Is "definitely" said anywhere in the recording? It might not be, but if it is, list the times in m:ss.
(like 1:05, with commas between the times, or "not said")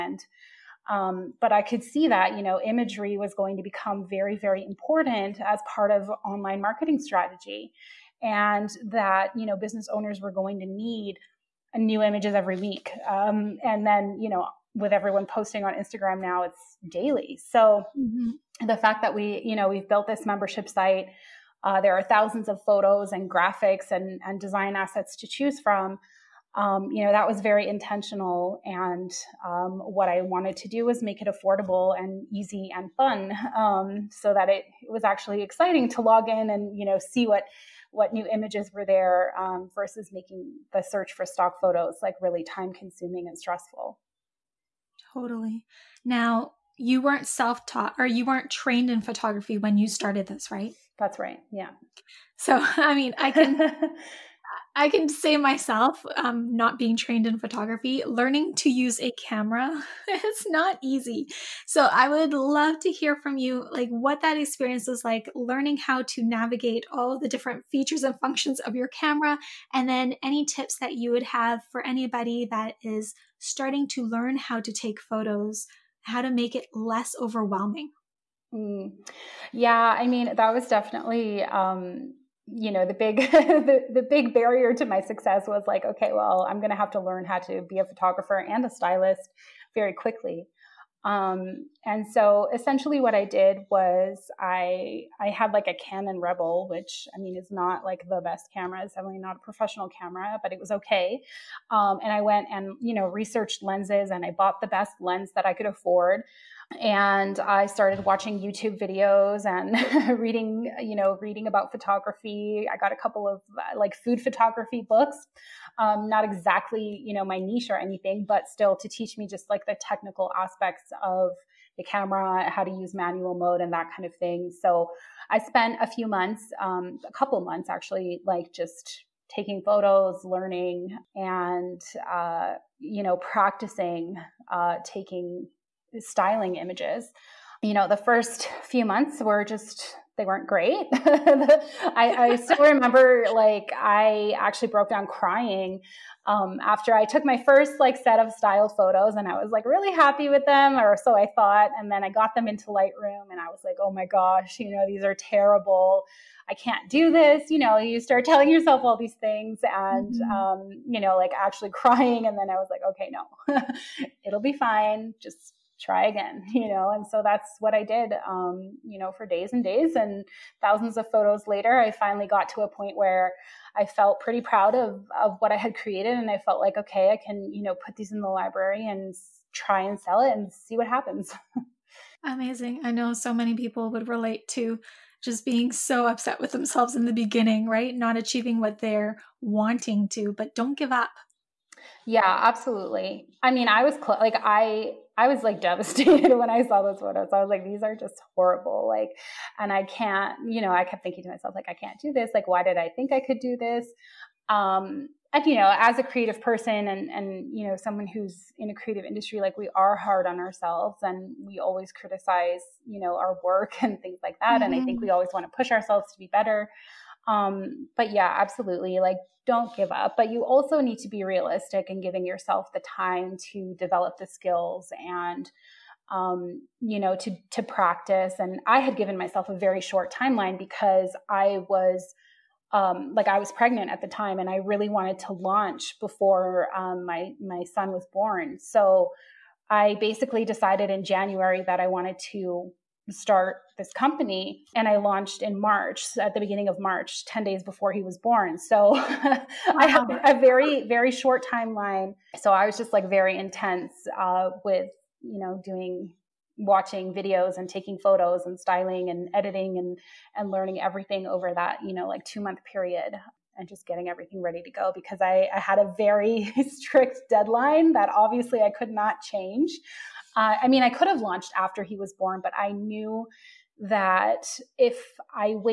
1:20, 1:38.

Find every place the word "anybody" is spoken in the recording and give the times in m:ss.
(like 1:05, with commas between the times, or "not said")
1:11.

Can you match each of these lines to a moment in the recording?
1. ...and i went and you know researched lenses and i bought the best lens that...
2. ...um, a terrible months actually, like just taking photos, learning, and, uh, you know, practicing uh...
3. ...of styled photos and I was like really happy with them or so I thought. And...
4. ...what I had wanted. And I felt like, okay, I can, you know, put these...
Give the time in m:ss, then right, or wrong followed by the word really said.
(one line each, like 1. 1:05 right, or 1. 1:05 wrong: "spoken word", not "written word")
1. 1:42 right
2. 2:06 wrong: "couple", not "terrible"
3. 2:28 right
4. 2:55 wrong: "created", not "wanted".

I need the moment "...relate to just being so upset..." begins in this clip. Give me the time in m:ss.
3:04.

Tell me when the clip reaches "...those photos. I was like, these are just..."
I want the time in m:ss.
3:16.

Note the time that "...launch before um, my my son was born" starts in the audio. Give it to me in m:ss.
3:55.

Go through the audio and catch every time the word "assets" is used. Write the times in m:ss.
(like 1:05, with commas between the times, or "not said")
0:24.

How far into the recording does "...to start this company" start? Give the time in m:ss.
4:02.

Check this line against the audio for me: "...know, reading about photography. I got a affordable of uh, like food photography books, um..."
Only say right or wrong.
wrong.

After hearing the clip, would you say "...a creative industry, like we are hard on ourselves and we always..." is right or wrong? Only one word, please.
right.